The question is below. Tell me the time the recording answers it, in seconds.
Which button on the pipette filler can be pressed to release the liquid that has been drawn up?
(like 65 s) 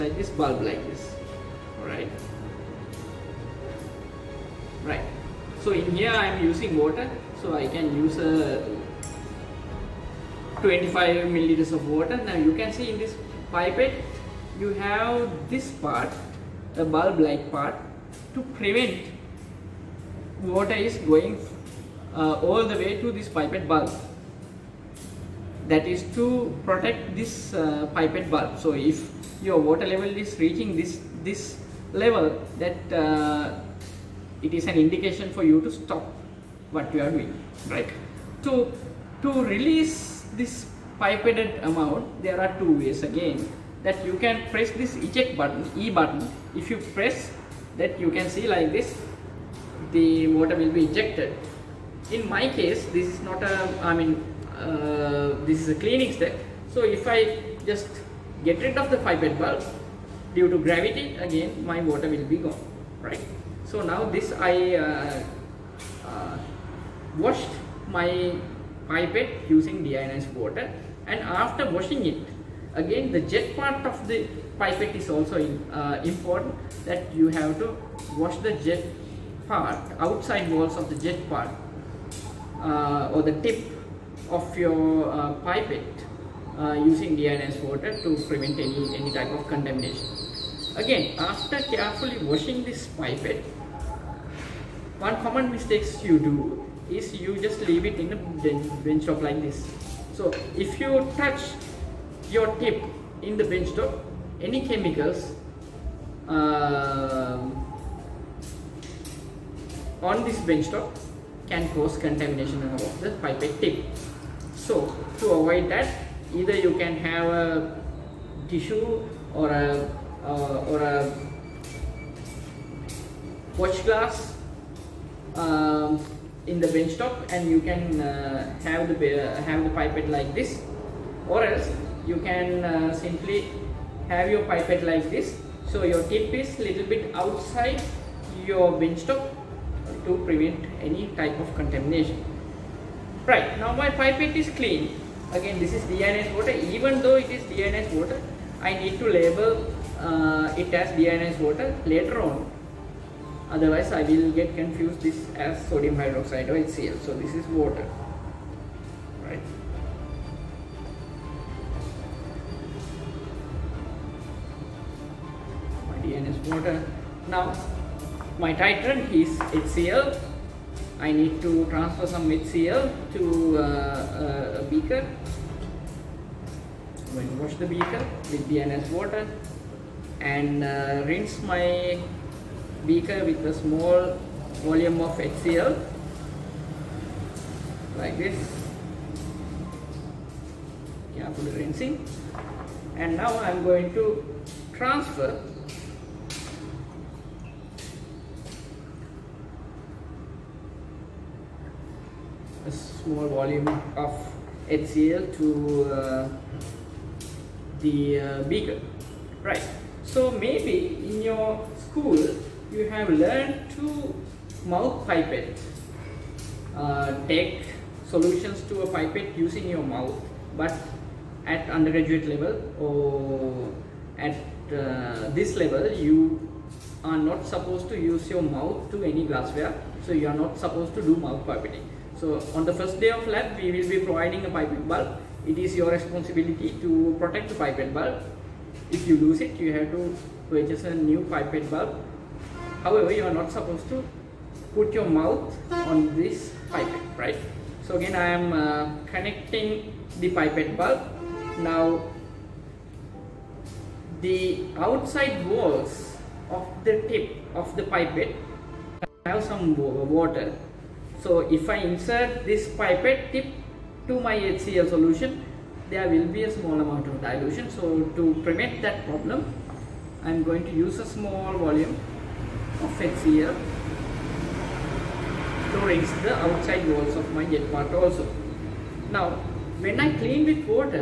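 44 s.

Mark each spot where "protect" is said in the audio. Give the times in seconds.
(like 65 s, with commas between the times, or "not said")
26 s, 237 s.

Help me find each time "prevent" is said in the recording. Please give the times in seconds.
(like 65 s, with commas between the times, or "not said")
18 s, 88 s, 140 s, 268 s.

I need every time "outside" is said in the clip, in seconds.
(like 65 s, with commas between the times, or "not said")
79 s, 137 s, 254 s, 276 s.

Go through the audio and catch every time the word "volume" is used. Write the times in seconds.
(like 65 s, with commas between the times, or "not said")
184 s, 203 s, 271 s.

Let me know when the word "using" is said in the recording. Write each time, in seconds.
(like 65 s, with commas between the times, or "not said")
6 s, 69 s, 86 s, 219 s.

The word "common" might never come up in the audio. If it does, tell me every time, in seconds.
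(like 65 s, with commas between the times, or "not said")
95 s.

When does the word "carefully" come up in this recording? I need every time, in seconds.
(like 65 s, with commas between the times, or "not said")
91 s, 191 s.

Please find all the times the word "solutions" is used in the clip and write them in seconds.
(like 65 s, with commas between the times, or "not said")
218 s, 264 s.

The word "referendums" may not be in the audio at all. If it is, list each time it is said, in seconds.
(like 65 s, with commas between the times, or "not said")
not said.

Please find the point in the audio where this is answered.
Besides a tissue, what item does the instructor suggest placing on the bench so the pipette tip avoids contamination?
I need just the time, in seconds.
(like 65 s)
123 s.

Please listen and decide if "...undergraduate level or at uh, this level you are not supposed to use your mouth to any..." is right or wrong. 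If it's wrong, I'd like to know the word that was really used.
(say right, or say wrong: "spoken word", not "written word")
right.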